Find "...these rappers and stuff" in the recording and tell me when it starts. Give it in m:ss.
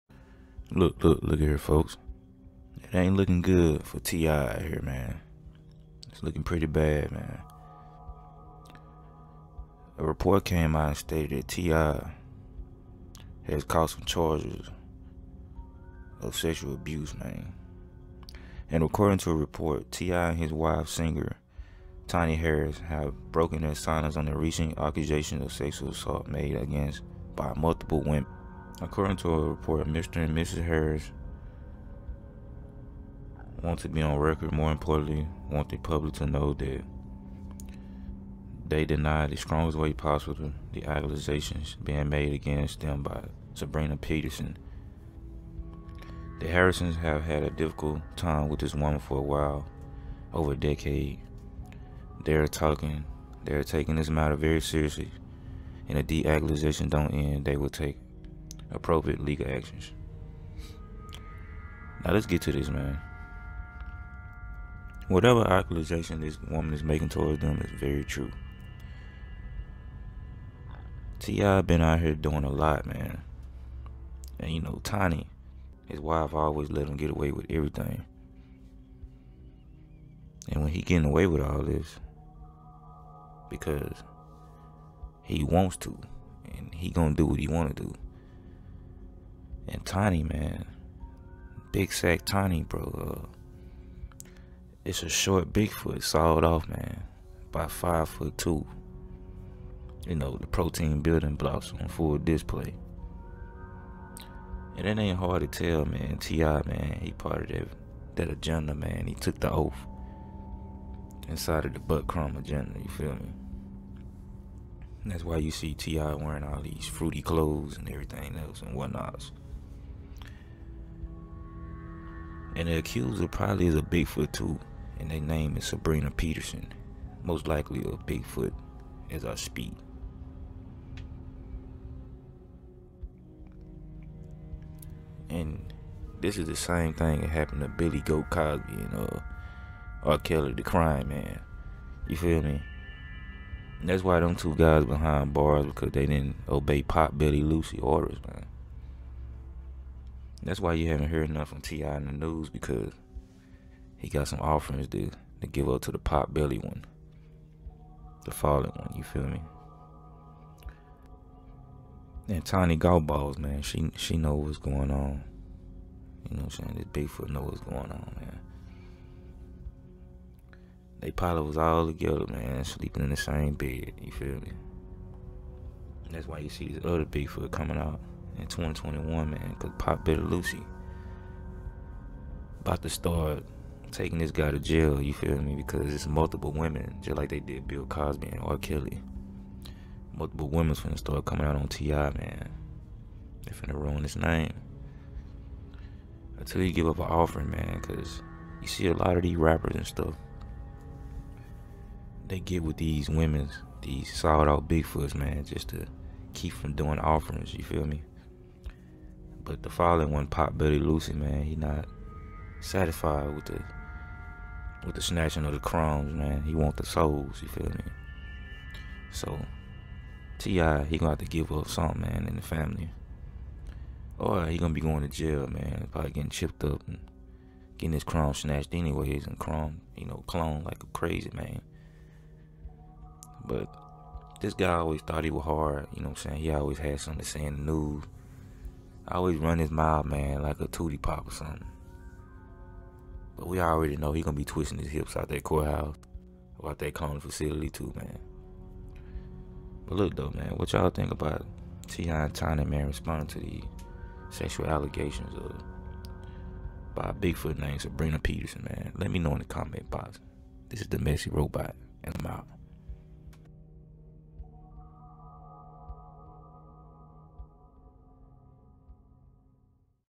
3:19.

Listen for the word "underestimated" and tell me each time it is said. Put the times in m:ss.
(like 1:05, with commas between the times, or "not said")
not said.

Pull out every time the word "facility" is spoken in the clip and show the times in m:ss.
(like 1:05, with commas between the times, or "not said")
4:07.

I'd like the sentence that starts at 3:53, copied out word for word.
But this guy always thought he was hard, you know what I'm saying?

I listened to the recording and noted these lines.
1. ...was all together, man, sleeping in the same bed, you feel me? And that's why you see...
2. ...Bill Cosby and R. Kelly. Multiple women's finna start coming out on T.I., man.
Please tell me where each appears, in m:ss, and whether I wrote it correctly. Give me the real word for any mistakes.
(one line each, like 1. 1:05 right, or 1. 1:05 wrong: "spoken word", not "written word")
1. 2:51 right
2. 3:07 right.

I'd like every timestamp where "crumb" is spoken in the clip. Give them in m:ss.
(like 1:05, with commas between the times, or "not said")
1:52, 3:35.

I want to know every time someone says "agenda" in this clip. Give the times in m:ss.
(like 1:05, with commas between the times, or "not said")
1:48, 1:52.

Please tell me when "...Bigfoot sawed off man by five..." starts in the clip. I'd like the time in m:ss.
1:35.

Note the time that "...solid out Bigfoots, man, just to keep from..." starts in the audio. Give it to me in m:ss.
3:24.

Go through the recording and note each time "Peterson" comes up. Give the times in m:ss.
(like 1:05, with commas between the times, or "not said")
0:43, 2:06, 4:18.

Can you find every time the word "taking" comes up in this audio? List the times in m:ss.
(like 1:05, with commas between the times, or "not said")
0:53, 3:03.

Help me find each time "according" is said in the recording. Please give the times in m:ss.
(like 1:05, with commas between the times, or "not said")
0:18, 0:28.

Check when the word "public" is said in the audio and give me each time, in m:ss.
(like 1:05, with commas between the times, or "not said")
0:35.